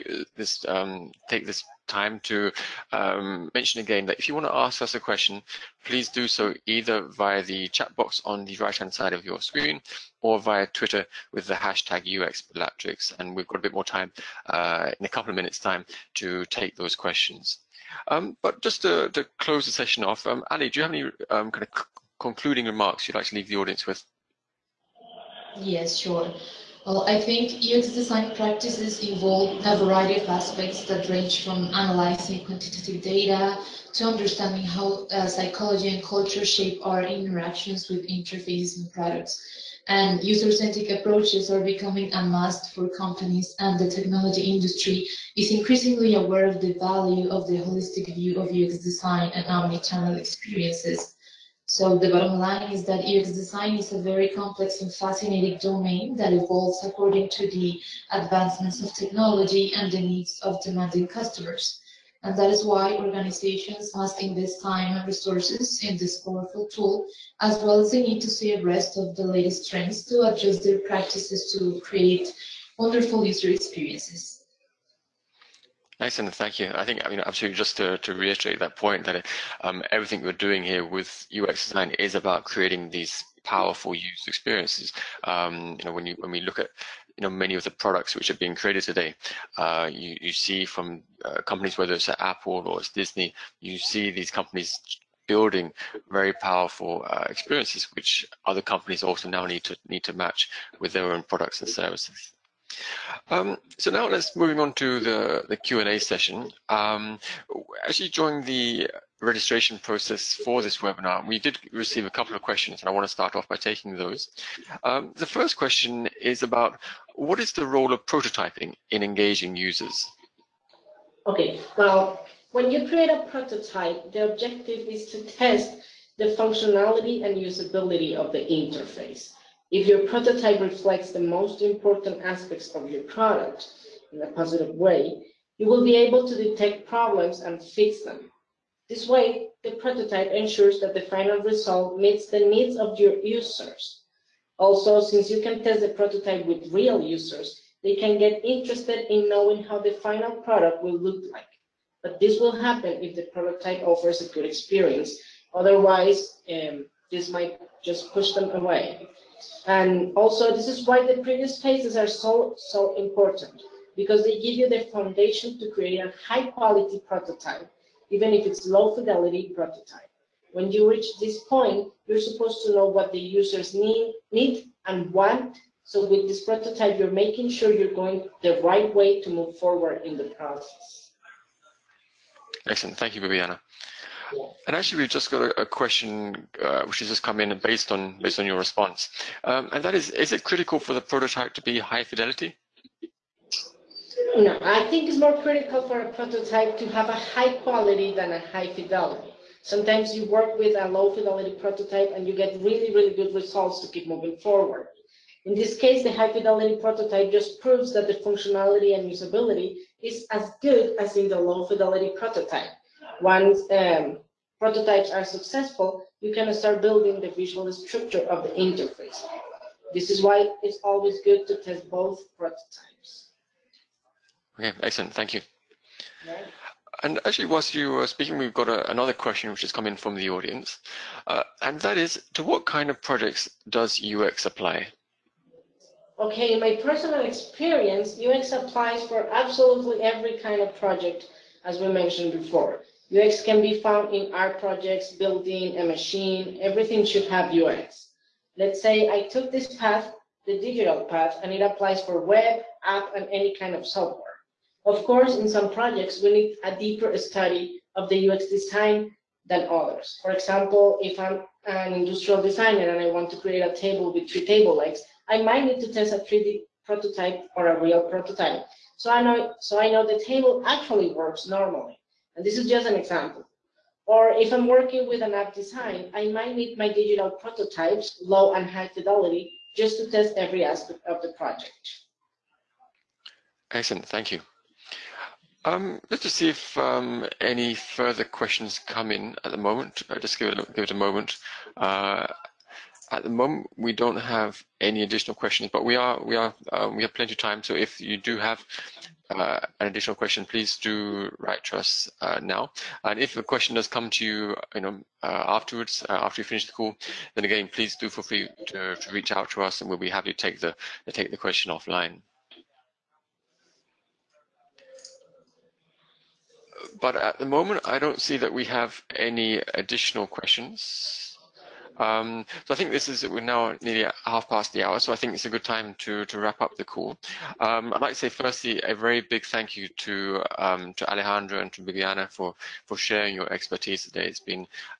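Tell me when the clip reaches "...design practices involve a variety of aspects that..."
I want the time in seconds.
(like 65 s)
27 s.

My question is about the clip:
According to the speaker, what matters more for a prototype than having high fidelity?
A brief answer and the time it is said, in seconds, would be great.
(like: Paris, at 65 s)
High quality, at 197 s.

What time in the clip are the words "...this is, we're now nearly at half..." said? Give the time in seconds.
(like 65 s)
322 s.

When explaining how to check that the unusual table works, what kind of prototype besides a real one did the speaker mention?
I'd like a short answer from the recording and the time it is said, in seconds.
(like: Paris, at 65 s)
3D prototype, at 266 s.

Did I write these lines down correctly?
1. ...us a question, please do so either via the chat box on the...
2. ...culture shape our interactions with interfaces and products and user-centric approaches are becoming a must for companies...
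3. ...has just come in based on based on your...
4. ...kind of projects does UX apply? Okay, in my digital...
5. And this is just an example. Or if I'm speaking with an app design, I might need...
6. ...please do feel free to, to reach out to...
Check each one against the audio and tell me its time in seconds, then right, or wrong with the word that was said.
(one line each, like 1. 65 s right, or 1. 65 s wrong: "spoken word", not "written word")
1. 4 s right
2. 36 s right
3. 187 s right
4. 232 s wrong: "personal", not "digital"
5. 272 s wrong: "working", not "speaking"
6. 307 s right.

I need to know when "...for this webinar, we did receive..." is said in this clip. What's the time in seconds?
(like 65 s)
110 s.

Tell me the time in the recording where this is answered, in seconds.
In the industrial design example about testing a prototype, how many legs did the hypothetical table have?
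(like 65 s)
264 s.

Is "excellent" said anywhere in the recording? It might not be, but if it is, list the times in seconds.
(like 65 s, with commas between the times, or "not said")
76 s, 182 s, 224 s, 283 s.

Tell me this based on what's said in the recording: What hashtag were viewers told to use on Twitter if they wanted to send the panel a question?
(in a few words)
UXBelatrix.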